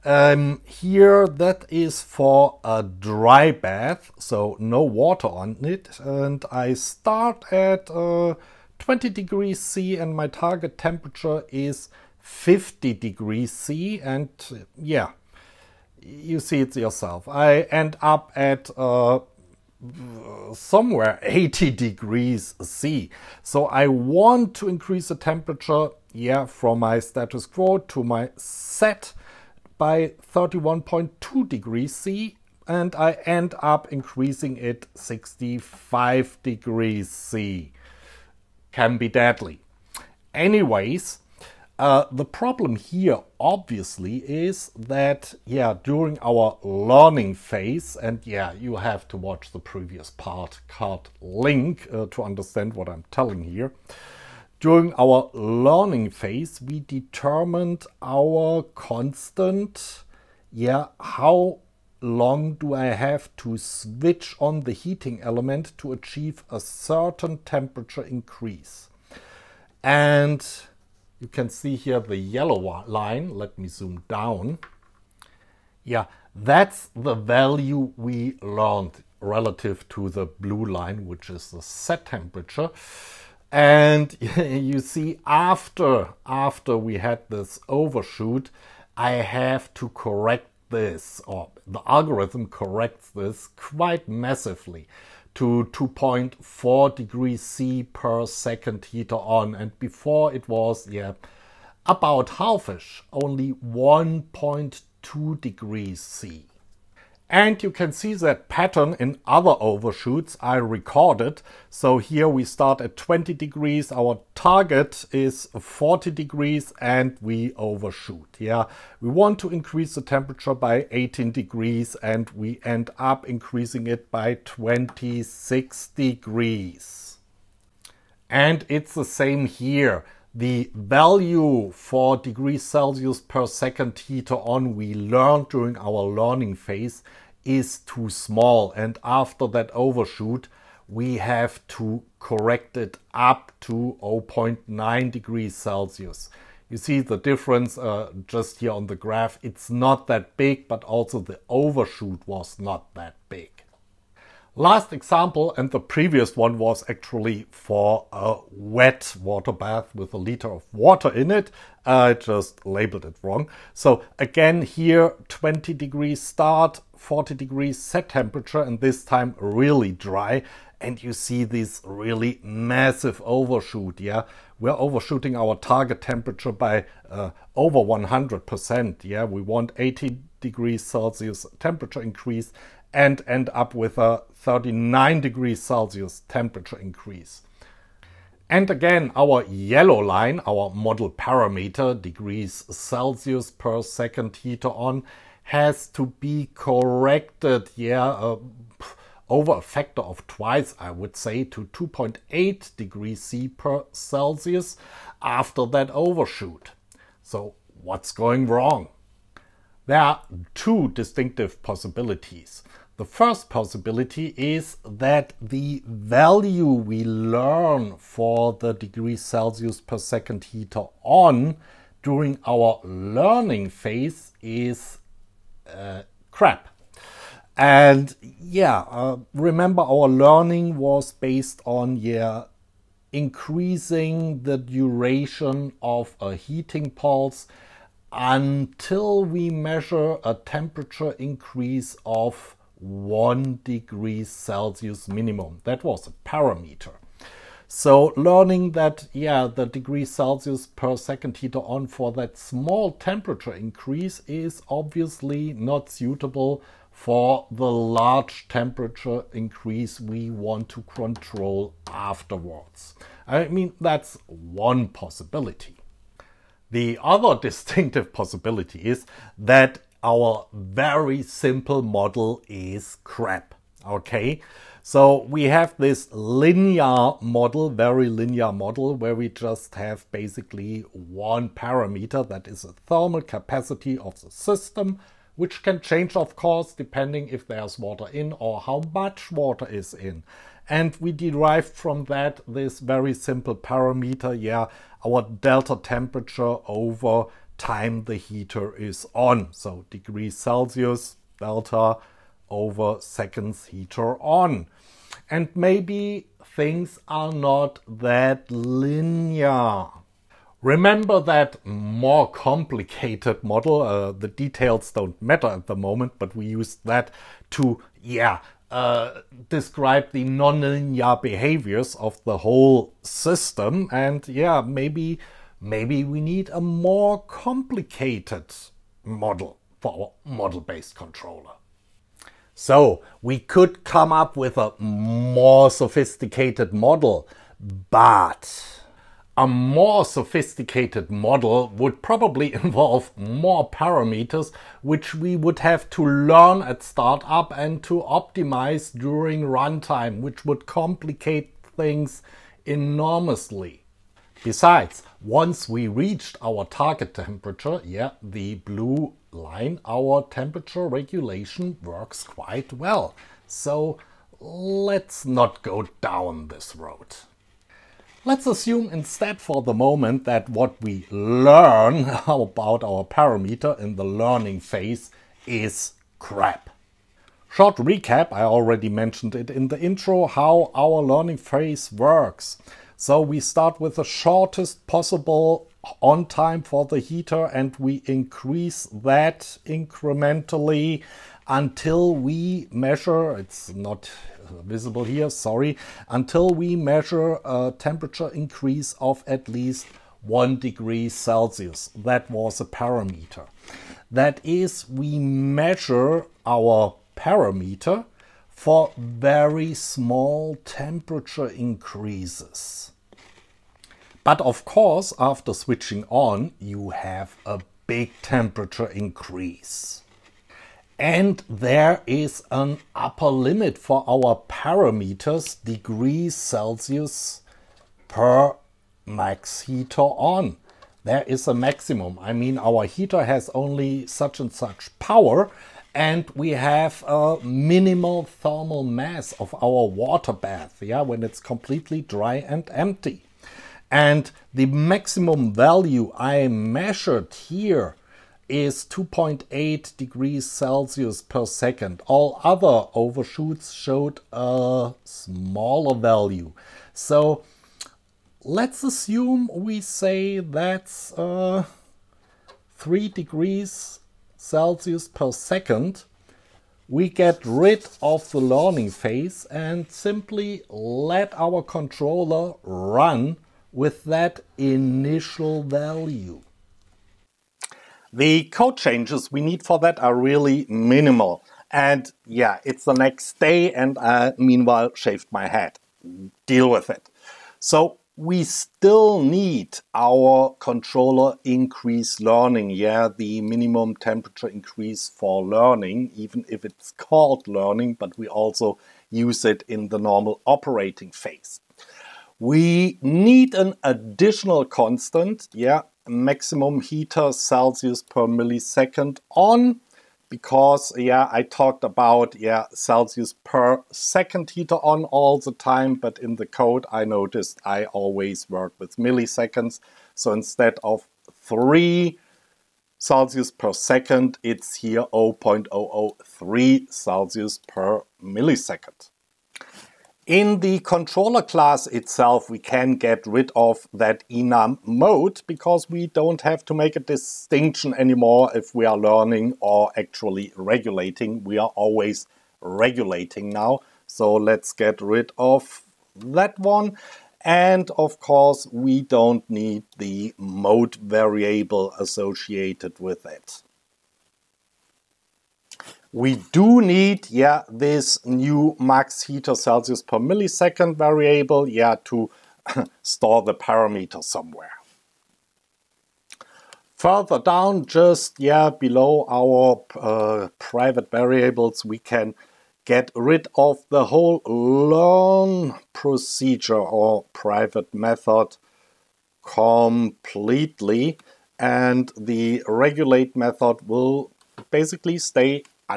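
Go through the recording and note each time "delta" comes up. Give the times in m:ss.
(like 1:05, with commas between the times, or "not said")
4:55, 5:01.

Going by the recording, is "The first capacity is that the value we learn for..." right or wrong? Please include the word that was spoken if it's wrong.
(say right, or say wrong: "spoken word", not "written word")
wrong: "possibility", not "capacity".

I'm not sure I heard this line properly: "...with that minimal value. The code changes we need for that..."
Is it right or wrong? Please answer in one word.
wrong.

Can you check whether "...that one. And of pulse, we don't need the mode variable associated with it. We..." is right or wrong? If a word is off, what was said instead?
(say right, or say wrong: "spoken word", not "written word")
wrong: "course", not "pulse".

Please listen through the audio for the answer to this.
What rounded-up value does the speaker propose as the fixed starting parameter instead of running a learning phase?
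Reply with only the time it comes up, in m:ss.
7:42.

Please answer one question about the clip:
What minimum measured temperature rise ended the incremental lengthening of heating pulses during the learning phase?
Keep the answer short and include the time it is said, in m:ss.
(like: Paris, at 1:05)
1 degree Celsius, at 4:02.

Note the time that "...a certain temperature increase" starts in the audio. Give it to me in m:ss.
1:06.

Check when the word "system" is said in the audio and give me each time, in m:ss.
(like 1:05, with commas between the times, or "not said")
4:44, 5:23.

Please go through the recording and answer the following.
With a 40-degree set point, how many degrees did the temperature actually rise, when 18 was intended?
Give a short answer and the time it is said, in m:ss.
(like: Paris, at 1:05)
26 degrees, at 2:04.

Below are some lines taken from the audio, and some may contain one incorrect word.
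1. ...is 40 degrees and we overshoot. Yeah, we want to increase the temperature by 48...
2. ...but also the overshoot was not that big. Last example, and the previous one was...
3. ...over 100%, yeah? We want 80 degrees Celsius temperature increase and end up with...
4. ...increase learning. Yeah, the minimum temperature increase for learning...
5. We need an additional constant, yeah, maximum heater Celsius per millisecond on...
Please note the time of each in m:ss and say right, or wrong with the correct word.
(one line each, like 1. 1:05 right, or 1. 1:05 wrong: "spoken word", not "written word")
1. 1:55 wrong: "18", not "48"
2. 2:30 right
3. 2:57 right
4. 8:11 right
5. 8:22 right.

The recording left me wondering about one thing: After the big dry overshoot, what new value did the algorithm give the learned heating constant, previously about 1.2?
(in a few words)
2.4 degrees C per second.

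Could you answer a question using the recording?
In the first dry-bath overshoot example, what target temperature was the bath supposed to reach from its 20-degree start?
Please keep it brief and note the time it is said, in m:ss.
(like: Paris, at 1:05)
50 degrees C, at 0:12.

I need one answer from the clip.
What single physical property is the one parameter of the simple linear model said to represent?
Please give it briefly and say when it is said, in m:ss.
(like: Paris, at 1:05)
thermal capacity, at 4:42.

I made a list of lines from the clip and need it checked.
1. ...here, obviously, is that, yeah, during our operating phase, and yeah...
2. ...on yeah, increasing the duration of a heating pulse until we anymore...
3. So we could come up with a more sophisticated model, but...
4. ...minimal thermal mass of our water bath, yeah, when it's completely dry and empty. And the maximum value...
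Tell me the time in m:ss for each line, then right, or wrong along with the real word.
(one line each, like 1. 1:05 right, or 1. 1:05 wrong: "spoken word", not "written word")
1. 0:42 wrong: "learning", not "operating"
2. 3:51 wrong: "measure", not "anymore"
3. 5:32 right
4. 7:17 right.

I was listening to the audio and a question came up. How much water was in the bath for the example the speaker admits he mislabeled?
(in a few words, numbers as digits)
a liter.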